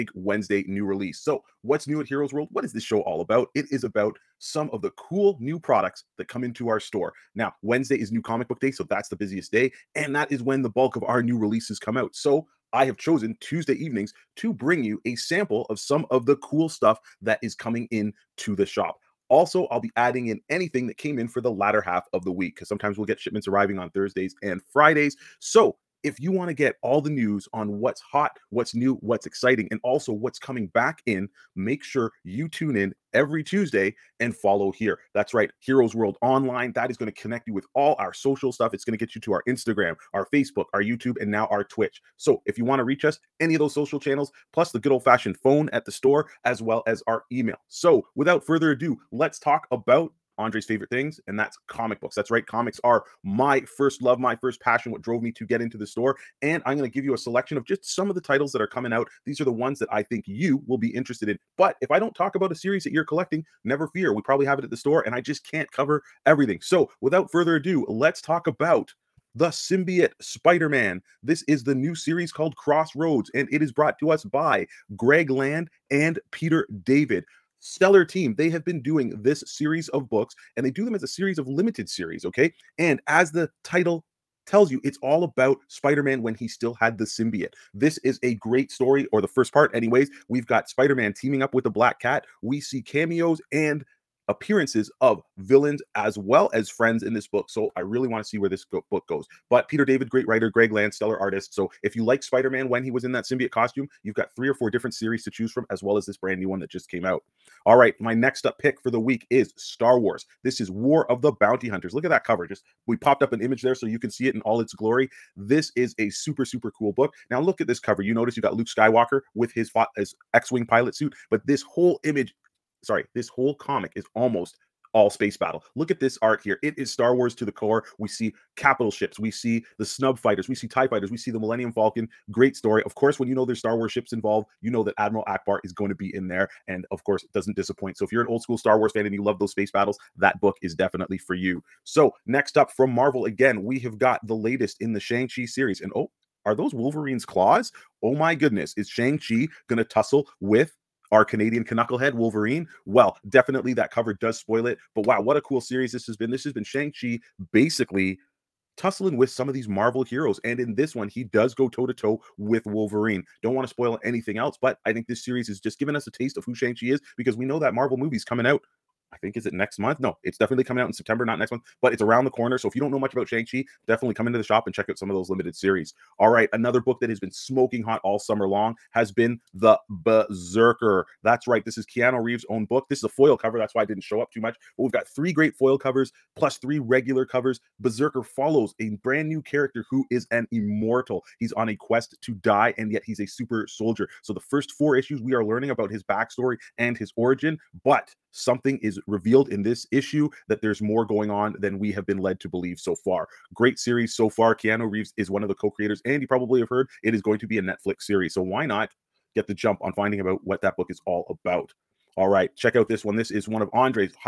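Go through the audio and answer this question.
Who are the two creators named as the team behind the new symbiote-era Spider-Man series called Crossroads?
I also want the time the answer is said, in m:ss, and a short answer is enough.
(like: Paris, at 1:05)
Greg Land and Peter David, at 1:14.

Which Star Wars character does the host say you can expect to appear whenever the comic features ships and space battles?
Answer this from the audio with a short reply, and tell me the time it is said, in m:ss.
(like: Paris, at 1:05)
Admiral Ackbar, at 2:14.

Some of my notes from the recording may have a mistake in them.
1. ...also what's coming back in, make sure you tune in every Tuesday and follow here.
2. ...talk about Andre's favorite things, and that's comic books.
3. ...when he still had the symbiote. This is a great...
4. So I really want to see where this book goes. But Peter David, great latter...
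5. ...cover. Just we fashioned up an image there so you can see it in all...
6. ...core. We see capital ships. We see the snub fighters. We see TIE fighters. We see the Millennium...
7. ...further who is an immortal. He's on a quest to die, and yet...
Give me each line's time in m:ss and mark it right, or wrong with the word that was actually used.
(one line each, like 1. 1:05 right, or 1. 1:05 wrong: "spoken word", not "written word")
1. 0:29 right
2. 0:49 right
3. 1:26 right
4. 1:37 wrong: "writer", not "latter"
5. 1:52 wrong: "popped", not "fashioned"
6. 2:07 right
7. 3:09 wrong: "character", not "further".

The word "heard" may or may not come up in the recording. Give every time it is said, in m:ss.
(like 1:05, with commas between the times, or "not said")
3:26.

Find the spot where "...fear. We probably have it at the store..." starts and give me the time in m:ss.
1:03.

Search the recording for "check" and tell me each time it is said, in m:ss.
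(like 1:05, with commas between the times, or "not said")
2:54, 3:32.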